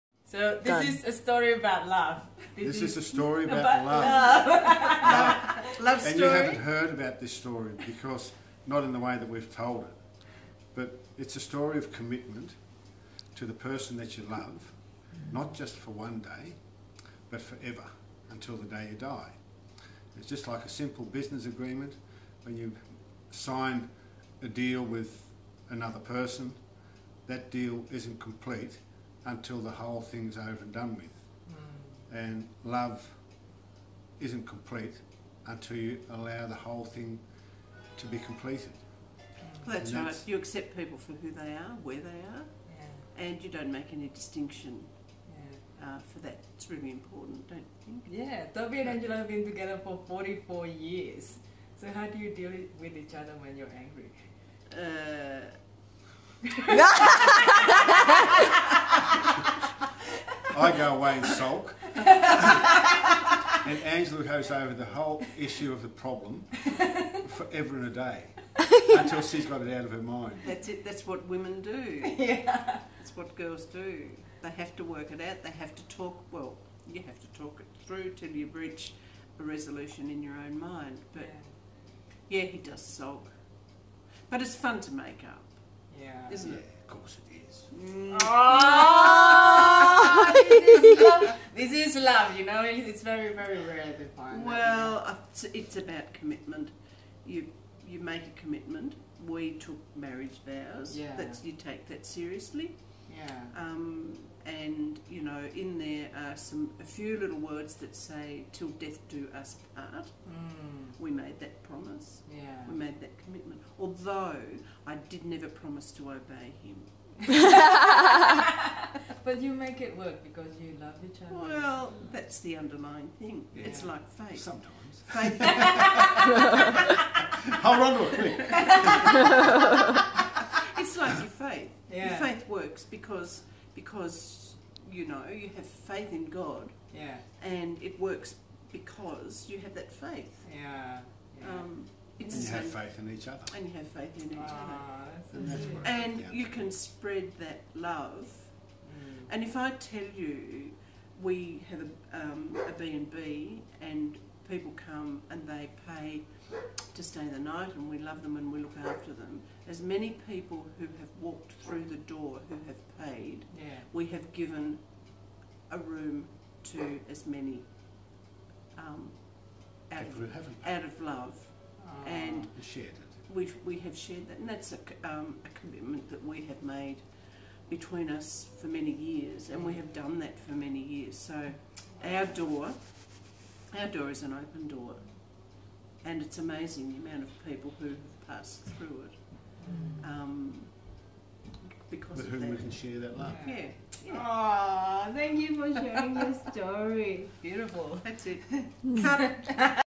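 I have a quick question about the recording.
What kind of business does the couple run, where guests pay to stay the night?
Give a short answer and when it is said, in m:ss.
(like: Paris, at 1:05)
B&B, at 2:32.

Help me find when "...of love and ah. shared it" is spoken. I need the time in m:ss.
2:50.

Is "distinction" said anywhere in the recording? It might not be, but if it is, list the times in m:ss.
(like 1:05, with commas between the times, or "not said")
0:44.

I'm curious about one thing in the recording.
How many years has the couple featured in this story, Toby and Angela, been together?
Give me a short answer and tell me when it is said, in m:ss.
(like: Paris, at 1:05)
44 years, at 0:50.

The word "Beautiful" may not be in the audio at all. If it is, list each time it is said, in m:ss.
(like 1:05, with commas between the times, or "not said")
3:17.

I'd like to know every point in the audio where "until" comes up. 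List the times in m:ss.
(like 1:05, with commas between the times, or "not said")
0:18, 0:29, 0:35, 1:08.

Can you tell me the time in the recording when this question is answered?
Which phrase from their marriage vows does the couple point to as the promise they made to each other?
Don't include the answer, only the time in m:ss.
1:48.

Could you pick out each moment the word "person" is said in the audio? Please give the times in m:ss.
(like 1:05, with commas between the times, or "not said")
0:13, 0:25.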